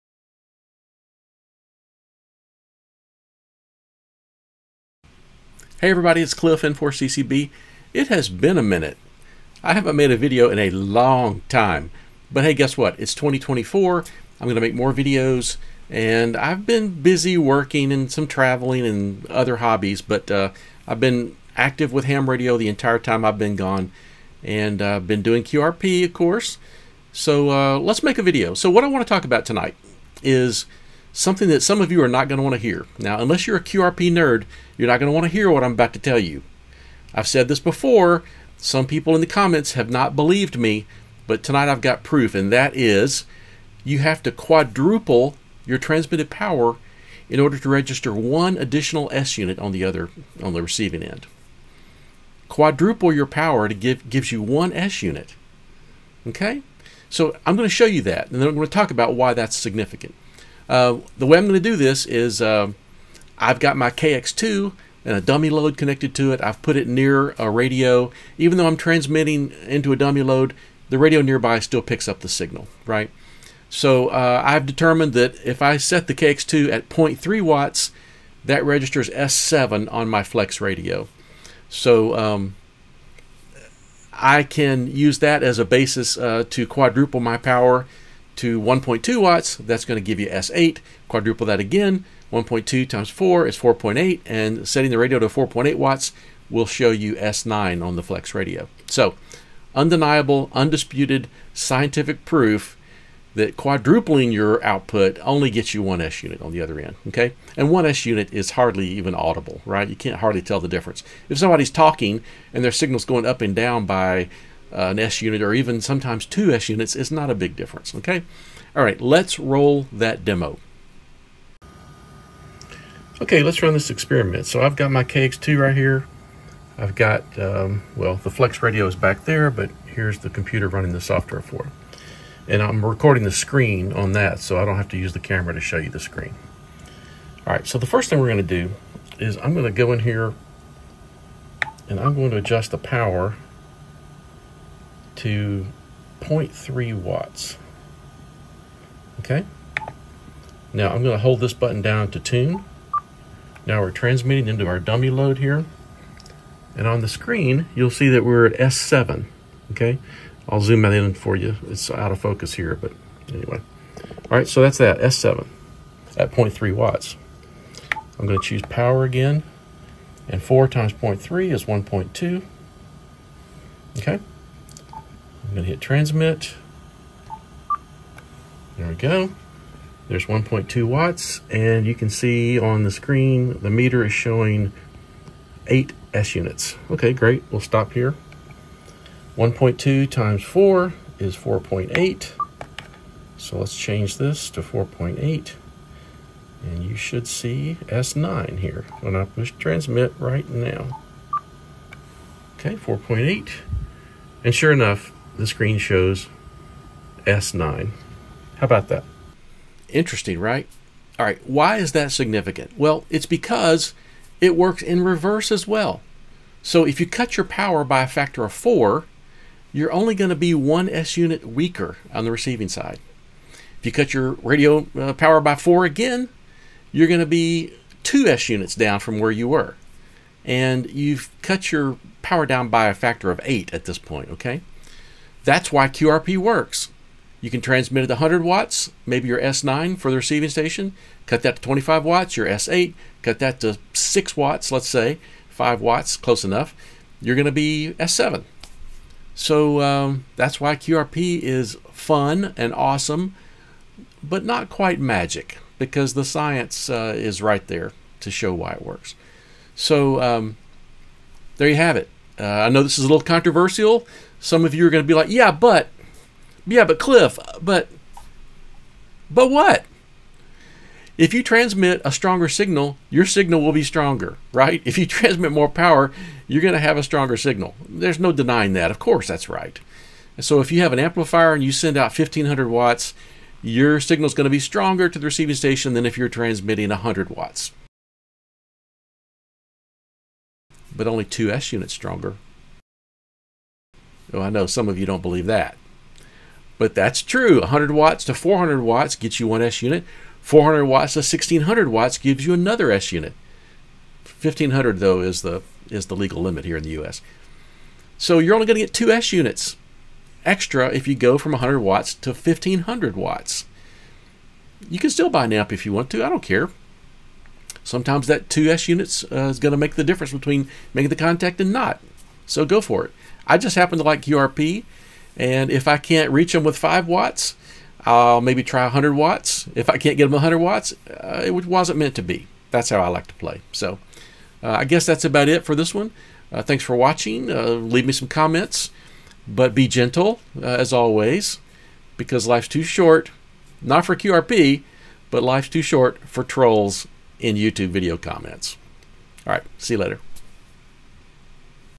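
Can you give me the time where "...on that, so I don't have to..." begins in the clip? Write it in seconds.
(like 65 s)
133 s.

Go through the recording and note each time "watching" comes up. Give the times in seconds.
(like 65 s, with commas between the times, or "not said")
336 s.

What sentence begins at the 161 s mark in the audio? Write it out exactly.
It's out of focus here, but anyway.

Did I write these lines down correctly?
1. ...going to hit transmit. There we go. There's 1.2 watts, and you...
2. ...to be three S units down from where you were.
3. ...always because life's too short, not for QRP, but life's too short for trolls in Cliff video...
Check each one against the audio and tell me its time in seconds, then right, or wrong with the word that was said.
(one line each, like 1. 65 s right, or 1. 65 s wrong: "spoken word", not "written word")
1. 175 s right
2. 227 s wrong: "two", not "three"
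3. 340 s wrong: "YouTube", not "Cliff".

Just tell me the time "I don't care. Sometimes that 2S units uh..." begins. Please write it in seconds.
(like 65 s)
316 s.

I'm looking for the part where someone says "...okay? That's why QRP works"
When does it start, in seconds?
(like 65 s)
234 s.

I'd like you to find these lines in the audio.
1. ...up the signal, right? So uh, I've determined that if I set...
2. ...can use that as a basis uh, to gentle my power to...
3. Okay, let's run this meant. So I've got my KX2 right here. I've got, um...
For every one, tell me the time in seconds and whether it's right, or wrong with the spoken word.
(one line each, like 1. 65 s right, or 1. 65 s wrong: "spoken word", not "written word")
1. 72 s right
2. 84 s wrong: "quadruple", not "gentle"
3. 123 s wrong: "experiment", not "meant".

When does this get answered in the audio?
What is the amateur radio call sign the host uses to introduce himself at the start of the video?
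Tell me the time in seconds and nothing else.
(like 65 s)
6 s.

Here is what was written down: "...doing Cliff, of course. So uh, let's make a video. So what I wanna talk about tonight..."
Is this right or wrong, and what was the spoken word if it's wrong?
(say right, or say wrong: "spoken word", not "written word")
wrong: "QRP", not "Cliff".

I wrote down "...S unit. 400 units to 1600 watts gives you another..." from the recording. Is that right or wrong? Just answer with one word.
wrong.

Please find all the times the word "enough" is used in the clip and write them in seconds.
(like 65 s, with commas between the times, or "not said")
204 s, 246 s.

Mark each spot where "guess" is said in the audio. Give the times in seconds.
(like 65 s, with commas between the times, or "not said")
12 s, 334 s.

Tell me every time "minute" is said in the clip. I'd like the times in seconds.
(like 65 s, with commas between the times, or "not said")
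8 s.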